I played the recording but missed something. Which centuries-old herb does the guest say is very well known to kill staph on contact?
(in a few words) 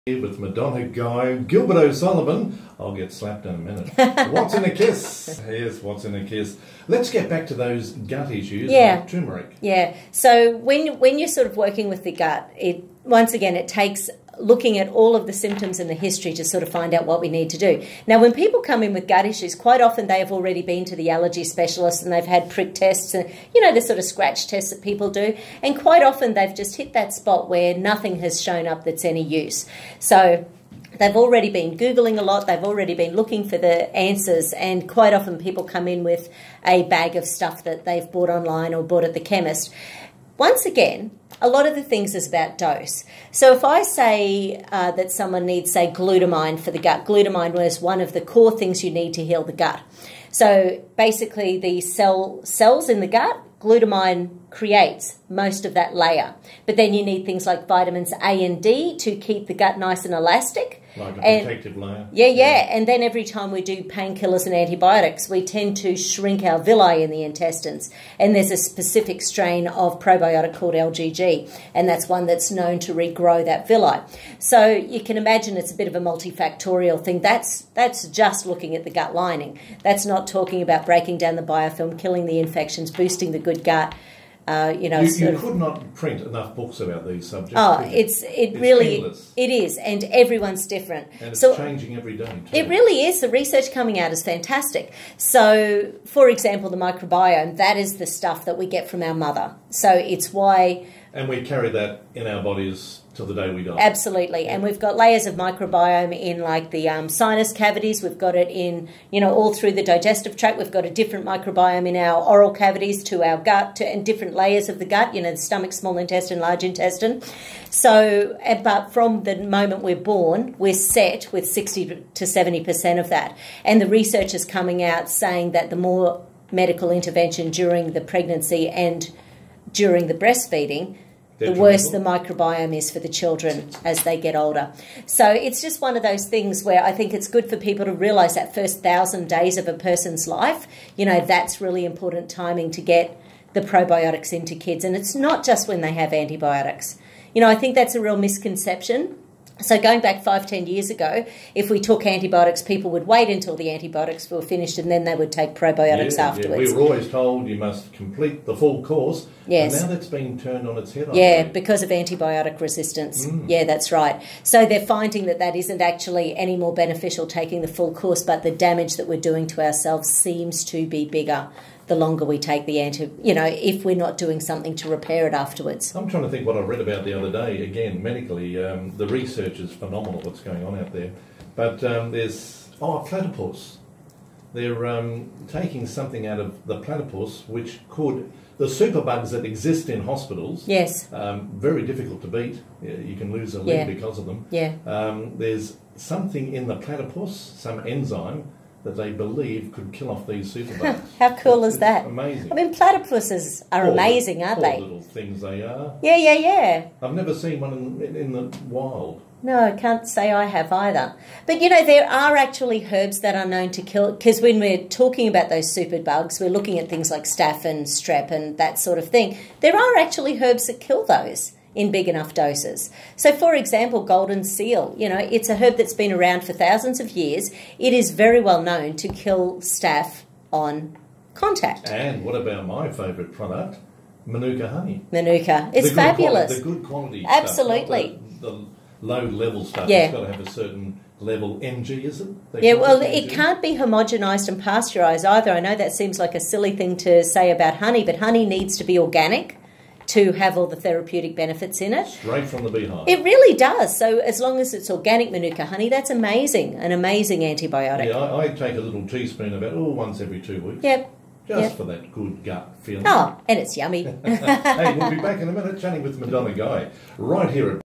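Golden seal.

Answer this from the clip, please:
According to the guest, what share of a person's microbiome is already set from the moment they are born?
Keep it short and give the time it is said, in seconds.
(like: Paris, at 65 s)
60 to 70%, at 121 s.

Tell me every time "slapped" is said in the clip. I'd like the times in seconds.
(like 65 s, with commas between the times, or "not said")
3 s.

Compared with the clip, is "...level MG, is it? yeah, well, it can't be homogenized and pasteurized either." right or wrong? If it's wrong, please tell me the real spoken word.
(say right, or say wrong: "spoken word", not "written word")
right.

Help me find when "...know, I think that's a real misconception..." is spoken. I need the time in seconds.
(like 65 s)
147 s.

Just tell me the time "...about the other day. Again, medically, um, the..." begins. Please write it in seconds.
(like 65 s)
176 s.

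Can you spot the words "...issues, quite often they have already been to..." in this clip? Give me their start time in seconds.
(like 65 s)
19 s.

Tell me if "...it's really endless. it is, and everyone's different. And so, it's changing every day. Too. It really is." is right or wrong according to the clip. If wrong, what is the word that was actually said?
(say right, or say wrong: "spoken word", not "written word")
right.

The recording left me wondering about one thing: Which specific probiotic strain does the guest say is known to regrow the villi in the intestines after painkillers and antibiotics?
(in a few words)
LGG.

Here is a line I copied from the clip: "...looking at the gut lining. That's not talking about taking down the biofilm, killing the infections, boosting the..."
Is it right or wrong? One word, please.
wrong.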